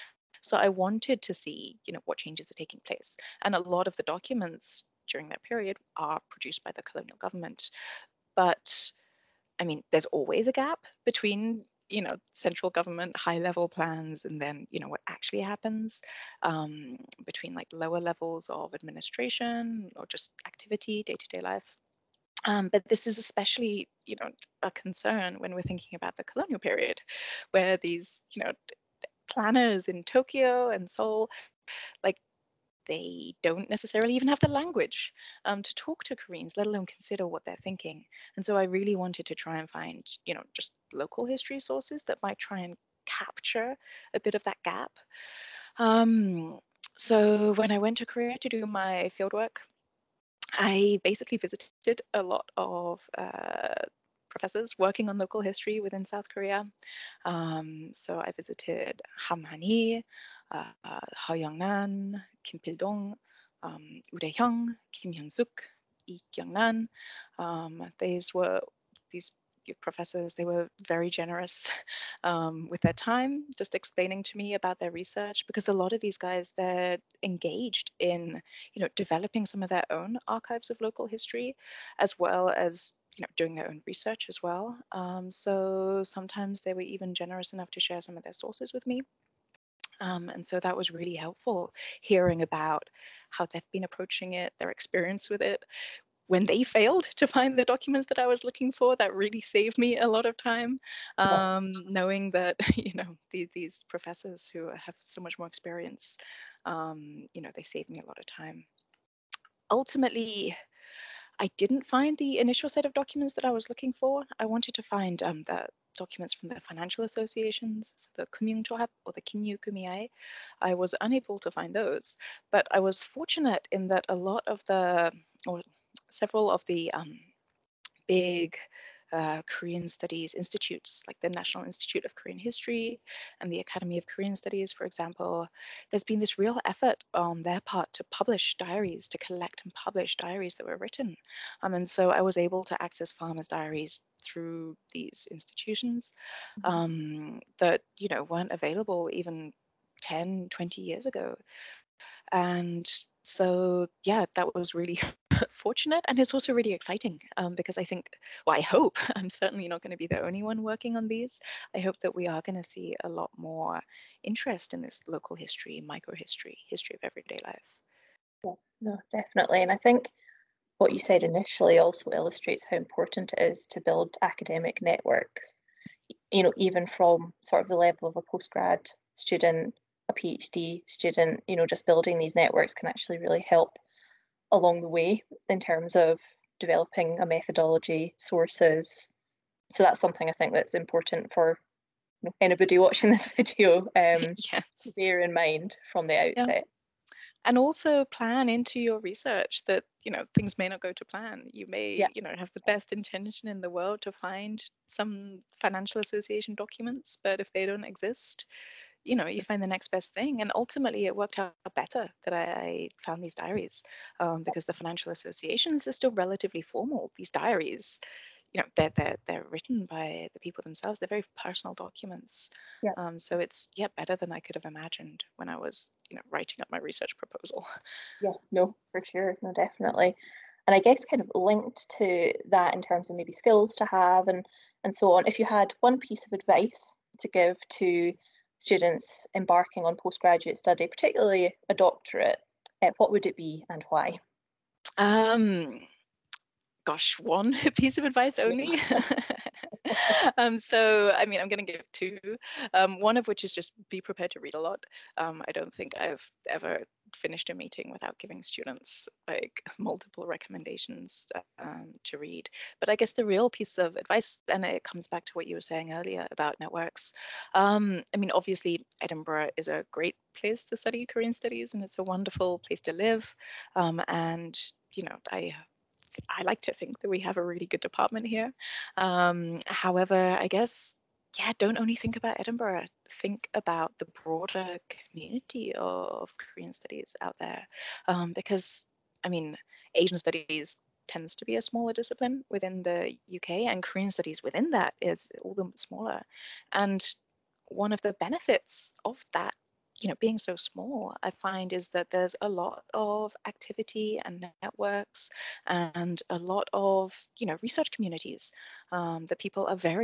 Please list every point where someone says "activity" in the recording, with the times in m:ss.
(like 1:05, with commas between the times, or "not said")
0:20, 5:03.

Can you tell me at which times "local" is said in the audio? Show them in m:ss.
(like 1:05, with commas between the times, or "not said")
0:40, 0:55, 1:20, 2:45.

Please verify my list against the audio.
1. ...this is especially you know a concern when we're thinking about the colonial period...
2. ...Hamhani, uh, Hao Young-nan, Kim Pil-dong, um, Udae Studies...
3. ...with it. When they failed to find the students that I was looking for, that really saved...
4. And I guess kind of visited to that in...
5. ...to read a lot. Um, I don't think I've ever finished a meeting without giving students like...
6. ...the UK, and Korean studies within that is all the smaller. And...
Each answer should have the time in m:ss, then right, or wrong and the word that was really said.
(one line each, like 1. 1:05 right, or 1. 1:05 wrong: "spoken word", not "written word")
1. 0:22 right
2. 0:59 wrong: "Hyung", not "Studies"
3. 1:35 wrong: "documents", not "students"
4. 3:50 wrong: "linked", not "visited"
5. 4:14 right
6. 4:52 right.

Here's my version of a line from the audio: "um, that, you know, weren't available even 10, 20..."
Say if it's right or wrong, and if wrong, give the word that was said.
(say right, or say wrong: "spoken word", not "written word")
right.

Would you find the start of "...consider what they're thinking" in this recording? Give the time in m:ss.
0:36.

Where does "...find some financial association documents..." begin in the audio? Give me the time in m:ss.
3:24.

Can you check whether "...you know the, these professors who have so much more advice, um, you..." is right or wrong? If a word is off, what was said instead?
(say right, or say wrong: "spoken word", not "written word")
wrong: "experience", not "advice".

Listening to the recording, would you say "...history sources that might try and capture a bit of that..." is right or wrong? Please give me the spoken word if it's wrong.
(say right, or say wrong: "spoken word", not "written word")
right.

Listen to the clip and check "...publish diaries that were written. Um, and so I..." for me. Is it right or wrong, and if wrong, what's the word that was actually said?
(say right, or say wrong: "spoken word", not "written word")
right.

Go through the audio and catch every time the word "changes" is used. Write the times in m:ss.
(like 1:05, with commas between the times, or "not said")
0:02.